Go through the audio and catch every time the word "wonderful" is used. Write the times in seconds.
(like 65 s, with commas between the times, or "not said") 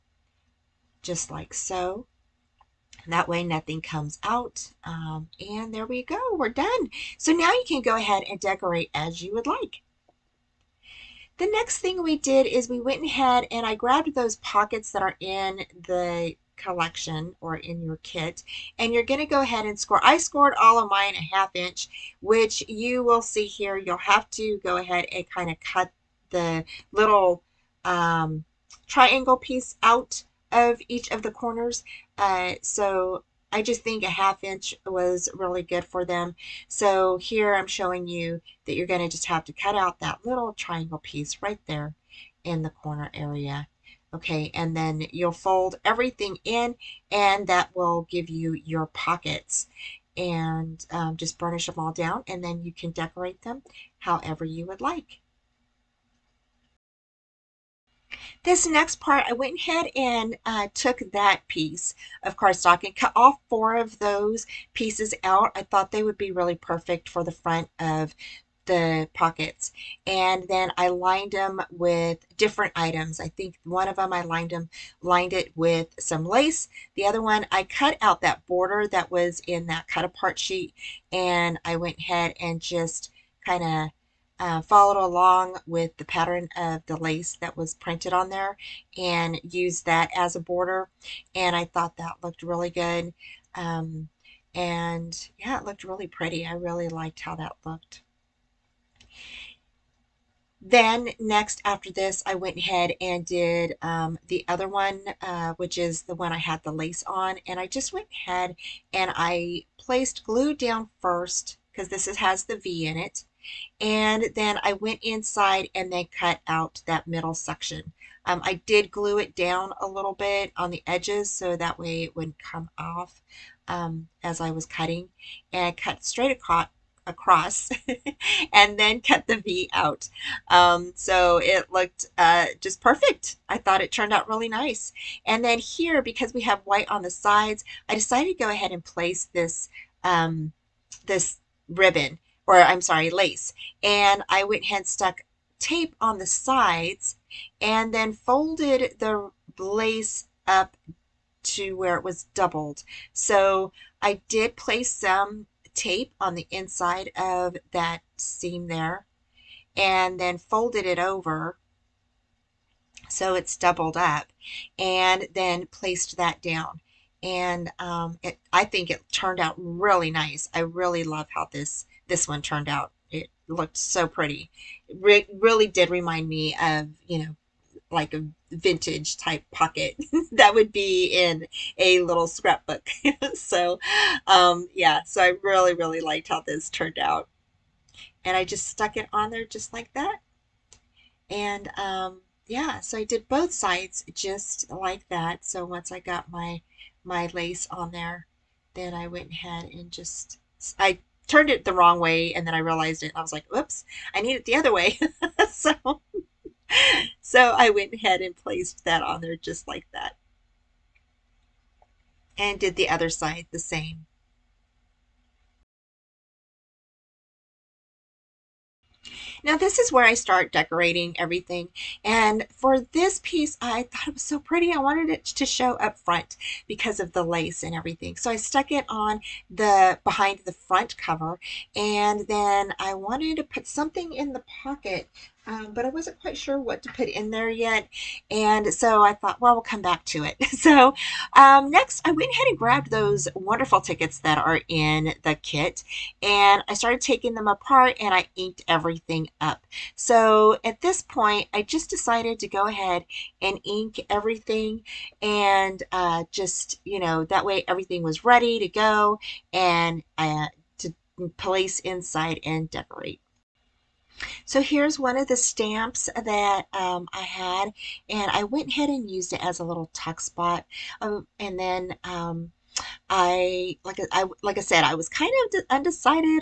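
243 s.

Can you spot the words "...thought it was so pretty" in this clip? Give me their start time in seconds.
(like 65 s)
223 s.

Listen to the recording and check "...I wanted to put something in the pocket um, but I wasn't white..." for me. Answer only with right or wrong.
wrong.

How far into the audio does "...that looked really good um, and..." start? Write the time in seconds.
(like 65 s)
91 s.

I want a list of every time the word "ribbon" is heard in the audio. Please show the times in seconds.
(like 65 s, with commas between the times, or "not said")
141 s.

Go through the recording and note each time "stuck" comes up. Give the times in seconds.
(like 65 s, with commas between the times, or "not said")
144 s, 188 s, 228 s.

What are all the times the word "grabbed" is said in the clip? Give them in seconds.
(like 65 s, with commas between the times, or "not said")
13 s, 242 s.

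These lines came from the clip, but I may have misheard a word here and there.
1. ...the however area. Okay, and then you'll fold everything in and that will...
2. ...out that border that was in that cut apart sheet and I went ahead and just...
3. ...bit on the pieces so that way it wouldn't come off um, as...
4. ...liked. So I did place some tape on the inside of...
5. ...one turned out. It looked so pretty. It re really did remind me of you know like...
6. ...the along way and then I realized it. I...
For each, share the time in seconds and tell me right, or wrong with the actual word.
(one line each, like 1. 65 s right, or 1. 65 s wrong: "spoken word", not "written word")
1. 42 s wrong: "corner", not "however"
2. 77 s right
3. 120 s wrong: "edges", not "pieces"
4. 152 s wrong: "doubled", not "liked"
5. 172 s right
6. 201 s wrong: "wrong", not "along".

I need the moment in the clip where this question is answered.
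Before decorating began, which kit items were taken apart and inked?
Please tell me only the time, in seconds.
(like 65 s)
243 s.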